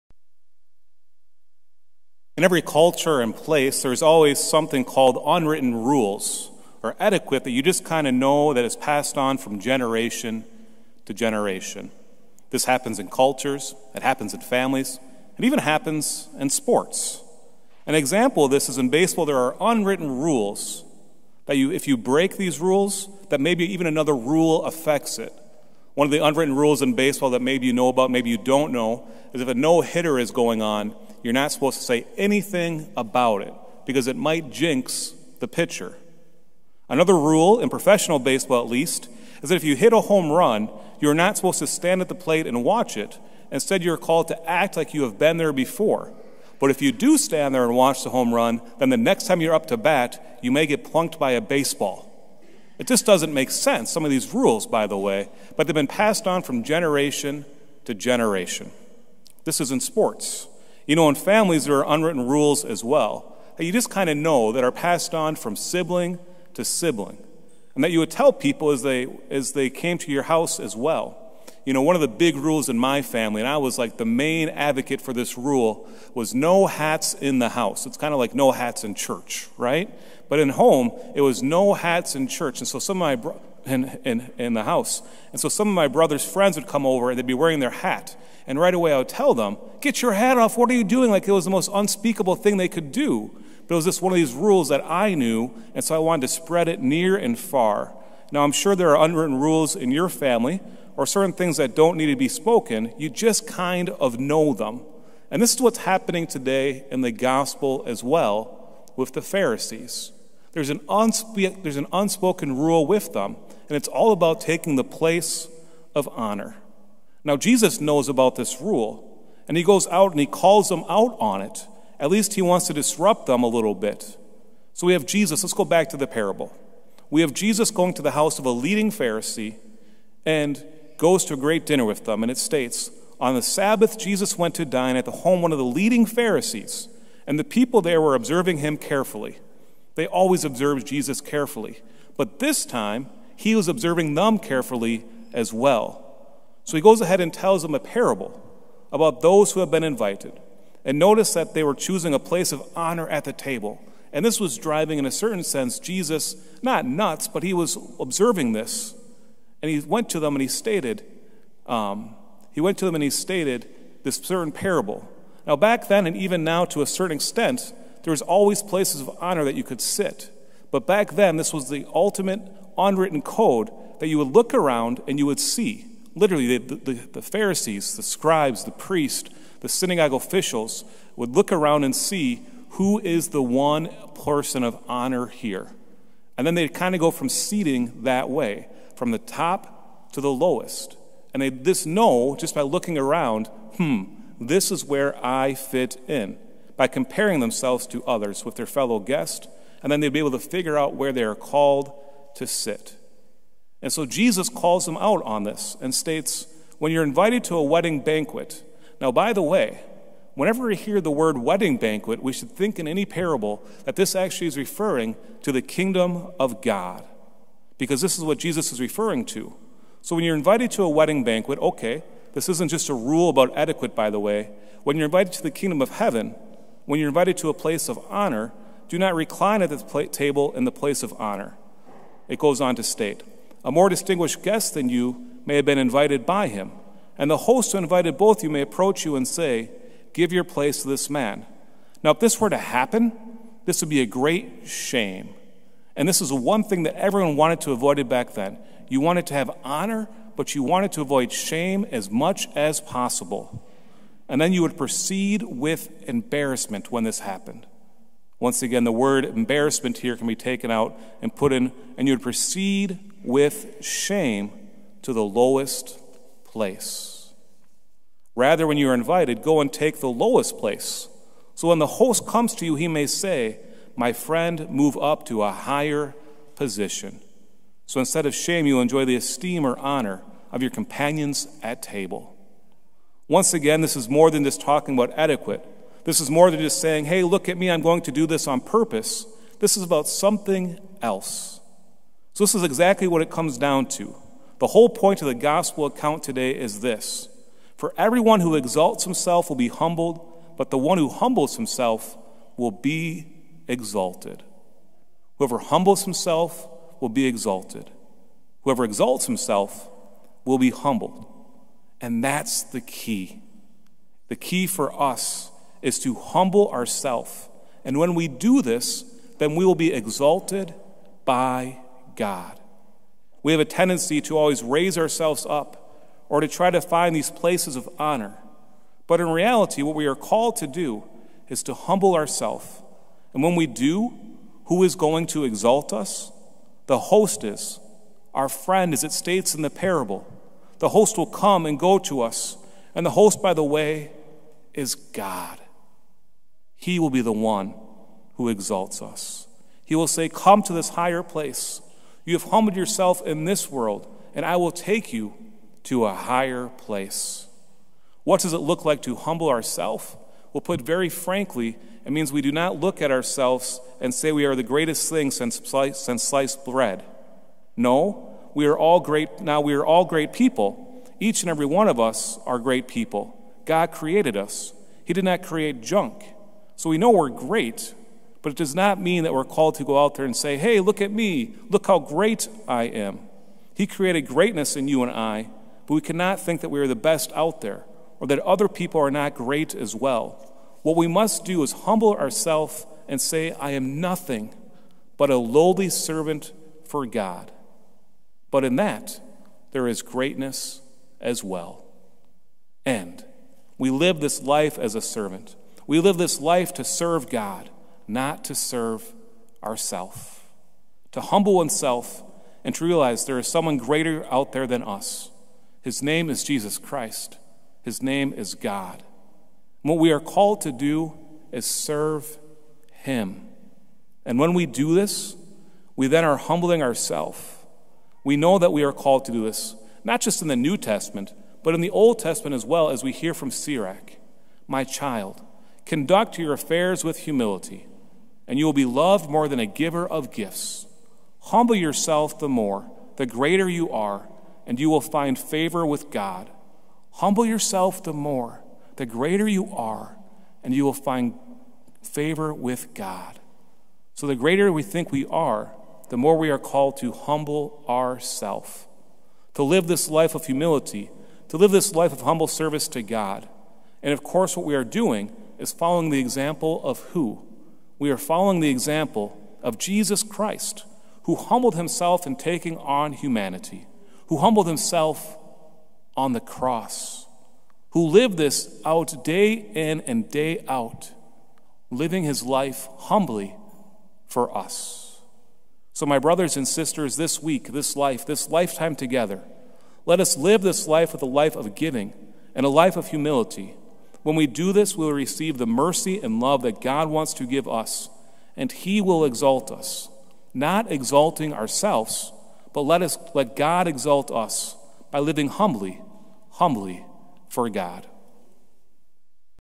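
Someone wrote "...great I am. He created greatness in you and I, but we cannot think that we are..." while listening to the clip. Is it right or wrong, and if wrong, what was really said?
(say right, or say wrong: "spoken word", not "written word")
right.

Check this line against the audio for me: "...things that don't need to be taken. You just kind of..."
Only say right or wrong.
wrong.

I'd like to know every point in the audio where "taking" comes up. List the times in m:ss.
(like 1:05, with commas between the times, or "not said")
1:54, 7:52.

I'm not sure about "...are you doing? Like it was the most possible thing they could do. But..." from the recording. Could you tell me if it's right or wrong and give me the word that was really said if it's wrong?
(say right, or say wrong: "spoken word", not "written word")
wrong: "unspeakable", not "possible".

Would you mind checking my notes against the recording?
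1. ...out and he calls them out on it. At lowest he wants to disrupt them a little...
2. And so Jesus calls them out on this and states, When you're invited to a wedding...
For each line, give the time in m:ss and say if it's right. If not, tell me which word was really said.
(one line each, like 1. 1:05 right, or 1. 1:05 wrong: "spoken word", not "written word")
1. 1:59 wrong: "least", not "lowest"
2. 3:23 right.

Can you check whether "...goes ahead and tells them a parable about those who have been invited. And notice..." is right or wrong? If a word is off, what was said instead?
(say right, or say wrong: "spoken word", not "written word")
right.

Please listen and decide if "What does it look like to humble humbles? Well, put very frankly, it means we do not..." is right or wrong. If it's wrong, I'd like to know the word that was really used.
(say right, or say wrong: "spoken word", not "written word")
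wrong: "ourselves", not "humbles".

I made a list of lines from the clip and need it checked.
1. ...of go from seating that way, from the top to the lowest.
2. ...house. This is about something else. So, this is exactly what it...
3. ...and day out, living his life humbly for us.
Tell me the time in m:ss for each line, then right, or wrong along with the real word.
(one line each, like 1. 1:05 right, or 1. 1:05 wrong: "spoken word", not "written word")
1. 3:06 right
2. 4:48 wrong: "purpose", not "house"
3. 8:00 right.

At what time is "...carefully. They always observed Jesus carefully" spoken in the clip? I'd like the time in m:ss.
2:18.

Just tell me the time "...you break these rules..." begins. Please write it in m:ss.
0:21.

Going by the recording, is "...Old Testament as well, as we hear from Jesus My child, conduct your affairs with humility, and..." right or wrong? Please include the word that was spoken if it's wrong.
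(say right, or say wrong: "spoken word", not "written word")
wrong: "Sirach", not "Jesus".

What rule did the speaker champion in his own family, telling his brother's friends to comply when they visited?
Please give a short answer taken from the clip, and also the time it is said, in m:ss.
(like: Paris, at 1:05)
No hats in the house, at 1:16.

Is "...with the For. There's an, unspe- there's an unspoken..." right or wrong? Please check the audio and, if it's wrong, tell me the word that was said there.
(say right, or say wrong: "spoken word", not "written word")
wrong: "Pharisees", not "For".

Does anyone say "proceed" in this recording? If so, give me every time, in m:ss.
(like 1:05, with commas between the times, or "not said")
4:14, 4:22.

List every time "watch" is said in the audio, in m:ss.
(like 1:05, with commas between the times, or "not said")
0:42, 0:47.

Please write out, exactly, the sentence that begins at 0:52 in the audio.
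It just doesn't make sense, some of these rules, by the way, but they've been passed on from generation to generation.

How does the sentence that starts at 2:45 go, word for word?
Now, back then, and even now to a certain extent, there was always places of honor that you could sit.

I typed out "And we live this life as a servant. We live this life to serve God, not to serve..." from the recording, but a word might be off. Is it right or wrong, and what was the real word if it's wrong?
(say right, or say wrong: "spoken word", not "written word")
right.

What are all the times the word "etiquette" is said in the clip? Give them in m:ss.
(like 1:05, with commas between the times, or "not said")
0:06, 3:43.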